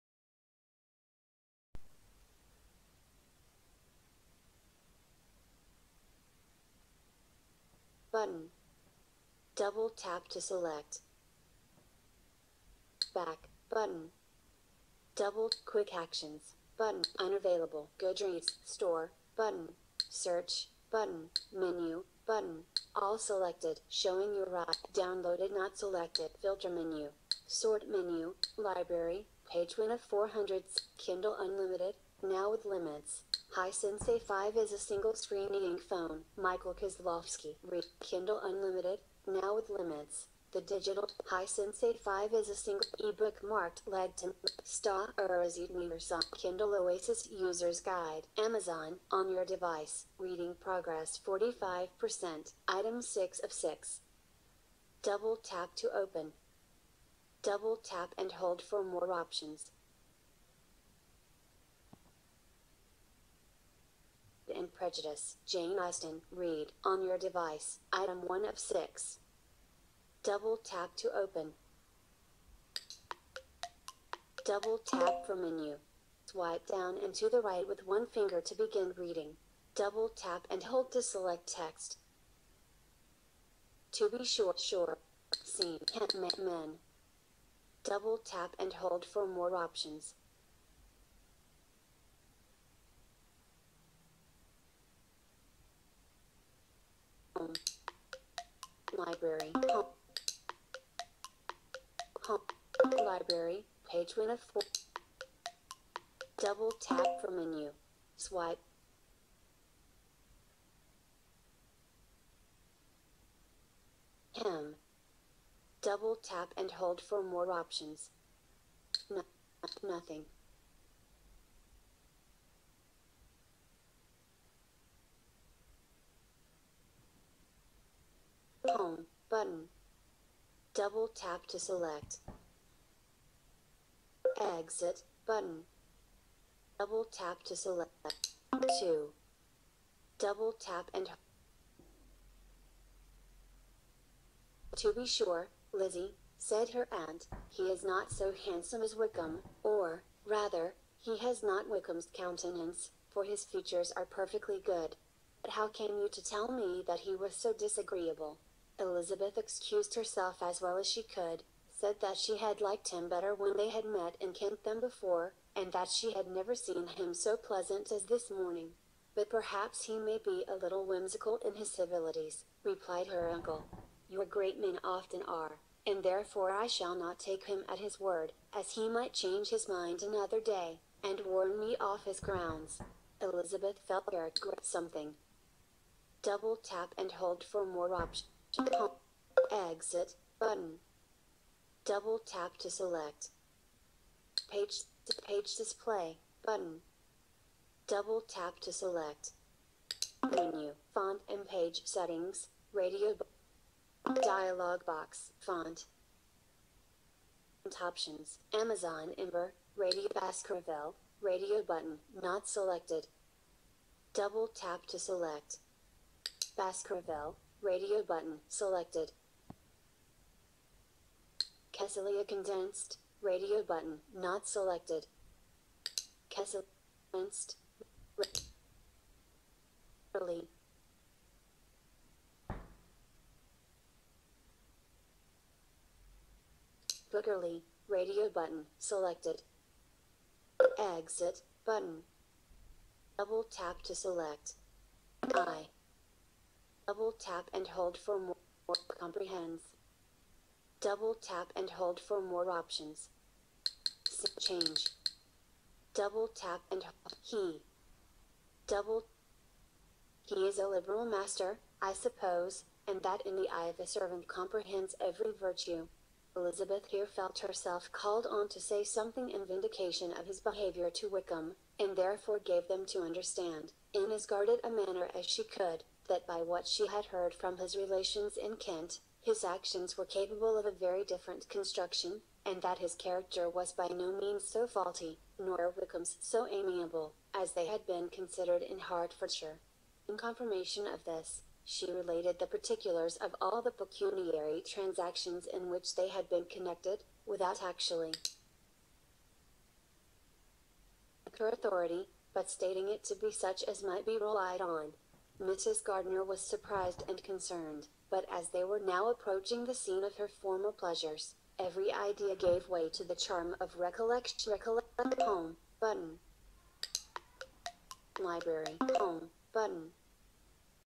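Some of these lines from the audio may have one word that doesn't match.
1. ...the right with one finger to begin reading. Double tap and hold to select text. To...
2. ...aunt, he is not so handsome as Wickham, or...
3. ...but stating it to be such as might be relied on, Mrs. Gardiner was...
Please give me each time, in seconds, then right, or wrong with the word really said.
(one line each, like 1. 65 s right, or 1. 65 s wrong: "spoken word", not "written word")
1. 77 s right
2. 146 s right
3. 302 s right.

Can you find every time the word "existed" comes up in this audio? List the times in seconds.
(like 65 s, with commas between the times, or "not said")
not said.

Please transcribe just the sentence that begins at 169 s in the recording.
But perhaps he may be a little whimsical in his civilities, replied her uncle.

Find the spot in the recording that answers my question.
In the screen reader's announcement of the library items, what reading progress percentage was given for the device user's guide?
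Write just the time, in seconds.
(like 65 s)
51 s.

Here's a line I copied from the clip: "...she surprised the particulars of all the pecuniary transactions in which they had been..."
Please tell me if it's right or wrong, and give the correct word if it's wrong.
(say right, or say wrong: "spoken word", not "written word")
wrong: "related", not "surprised".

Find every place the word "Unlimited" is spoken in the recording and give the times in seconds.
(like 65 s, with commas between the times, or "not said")
31 s, 38 s.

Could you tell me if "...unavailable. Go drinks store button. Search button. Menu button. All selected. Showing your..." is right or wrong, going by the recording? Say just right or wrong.
right.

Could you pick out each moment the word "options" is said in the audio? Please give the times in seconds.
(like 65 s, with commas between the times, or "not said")
59 s, 89 s, 117 s, 187 s, 207 s, 252 s.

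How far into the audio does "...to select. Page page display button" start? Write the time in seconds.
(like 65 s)
192 s.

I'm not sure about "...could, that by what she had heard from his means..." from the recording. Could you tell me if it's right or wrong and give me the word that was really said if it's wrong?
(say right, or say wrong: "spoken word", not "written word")
wrong: "relations", not "means".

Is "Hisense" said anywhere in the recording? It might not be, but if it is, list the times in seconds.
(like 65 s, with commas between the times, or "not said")
33 s, 41 s.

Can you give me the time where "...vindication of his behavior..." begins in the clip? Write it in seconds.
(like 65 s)
269 s.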